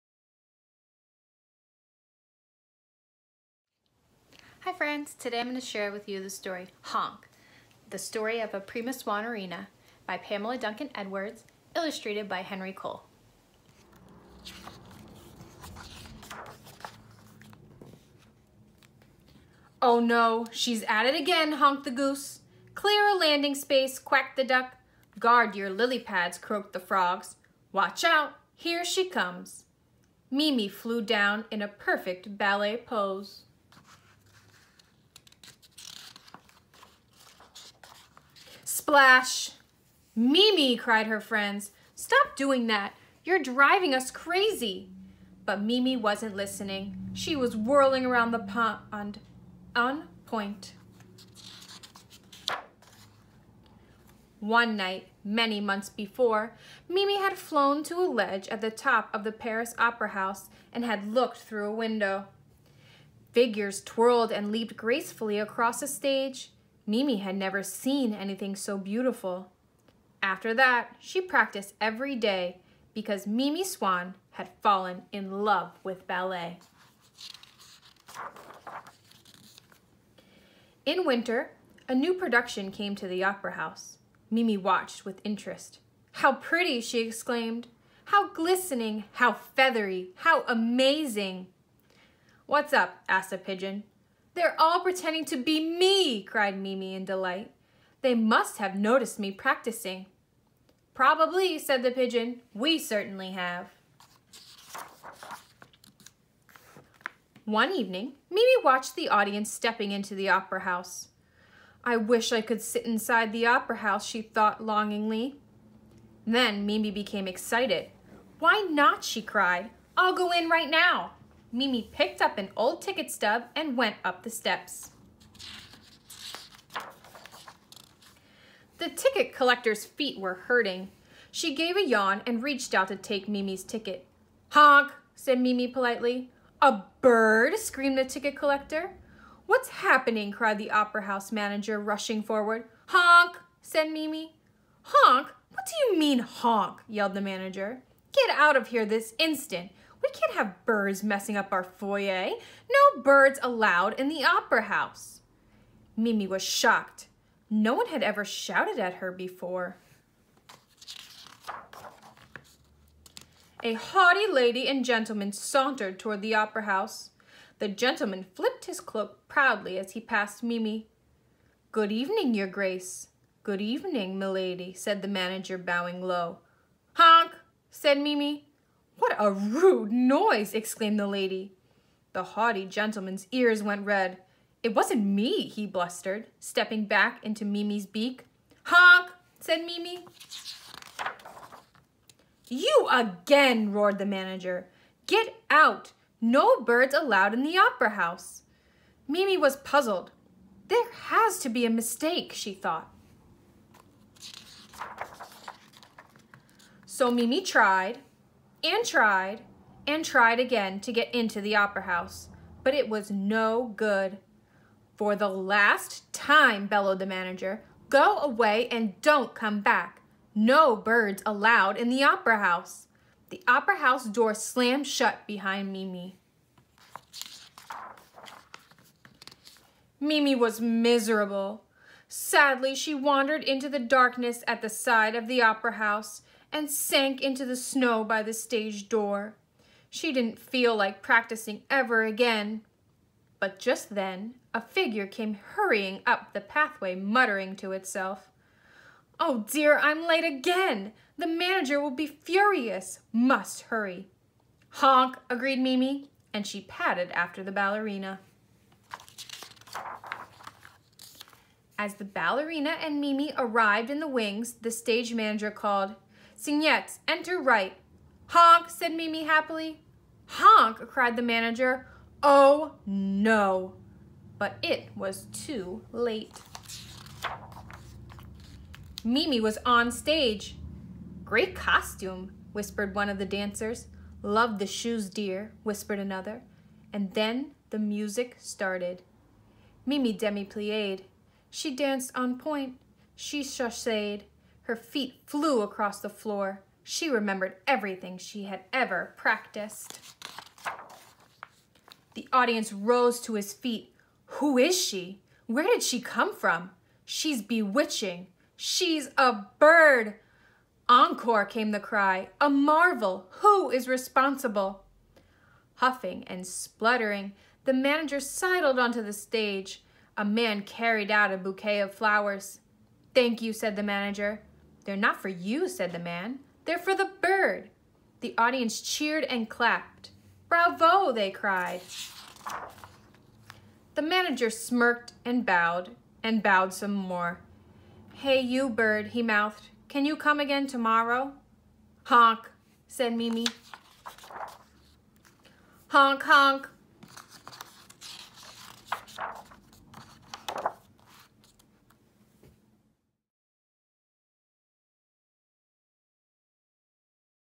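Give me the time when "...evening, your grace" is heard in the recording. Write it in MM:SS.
02:51.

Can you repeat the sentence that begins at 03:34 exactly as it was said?
For the last time, bellowed the manager, go away and don't come back.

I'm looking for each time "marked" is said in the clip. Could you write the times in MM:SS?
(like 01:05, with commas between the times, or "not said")
not said.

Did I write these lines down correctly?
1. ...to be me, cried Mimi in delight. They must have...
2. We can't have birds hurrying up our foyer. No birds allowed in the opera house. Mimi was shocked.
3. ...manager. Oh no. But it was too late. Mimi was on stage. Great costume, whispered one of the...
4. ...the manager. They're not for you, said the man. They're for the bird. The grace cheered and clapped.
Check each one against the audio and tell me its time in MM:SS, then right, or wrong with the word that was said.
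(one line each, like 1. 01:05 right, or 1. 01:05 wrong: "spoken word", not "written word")
1. 01:35 right
2. 02:30 wrong: "messing", not "hurrying"
3. 04:31 right
4. 05:23 wrong: "audience", not "grace".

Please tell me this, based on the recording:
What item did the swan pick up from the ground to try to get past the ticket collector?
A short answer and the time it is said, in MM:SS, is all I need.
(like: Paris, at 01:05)
An old ticket stub, at 02:02.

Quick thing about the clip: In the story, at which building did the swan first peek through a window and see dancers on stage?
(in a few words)
Paris Opera House.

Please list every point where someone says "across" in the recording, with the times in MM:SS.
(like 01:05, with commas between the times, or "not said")
01:05, 04:55.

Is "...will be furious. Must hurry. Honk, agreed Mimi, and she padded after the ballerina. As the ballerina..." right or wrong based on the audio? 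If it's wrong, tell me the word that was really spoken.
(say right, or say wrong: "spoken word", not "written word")
right.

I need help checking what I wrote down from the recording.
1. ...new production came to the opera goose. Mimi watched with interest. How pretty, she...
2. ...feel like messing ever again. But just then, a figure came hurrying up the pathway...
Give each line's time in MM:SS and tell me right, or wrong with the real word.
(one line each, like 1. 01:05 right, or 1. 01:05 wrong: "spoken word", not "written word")
1. 01:21 wrong: "house", not "goose"
2. 04:00 wrong: "practicing", not "messing".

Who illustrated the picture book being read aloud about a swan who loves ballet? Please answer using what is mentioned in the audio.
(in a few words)
Henry Cole.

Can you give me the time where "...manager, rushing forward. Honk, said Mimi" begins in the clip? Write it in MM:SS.
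02:21.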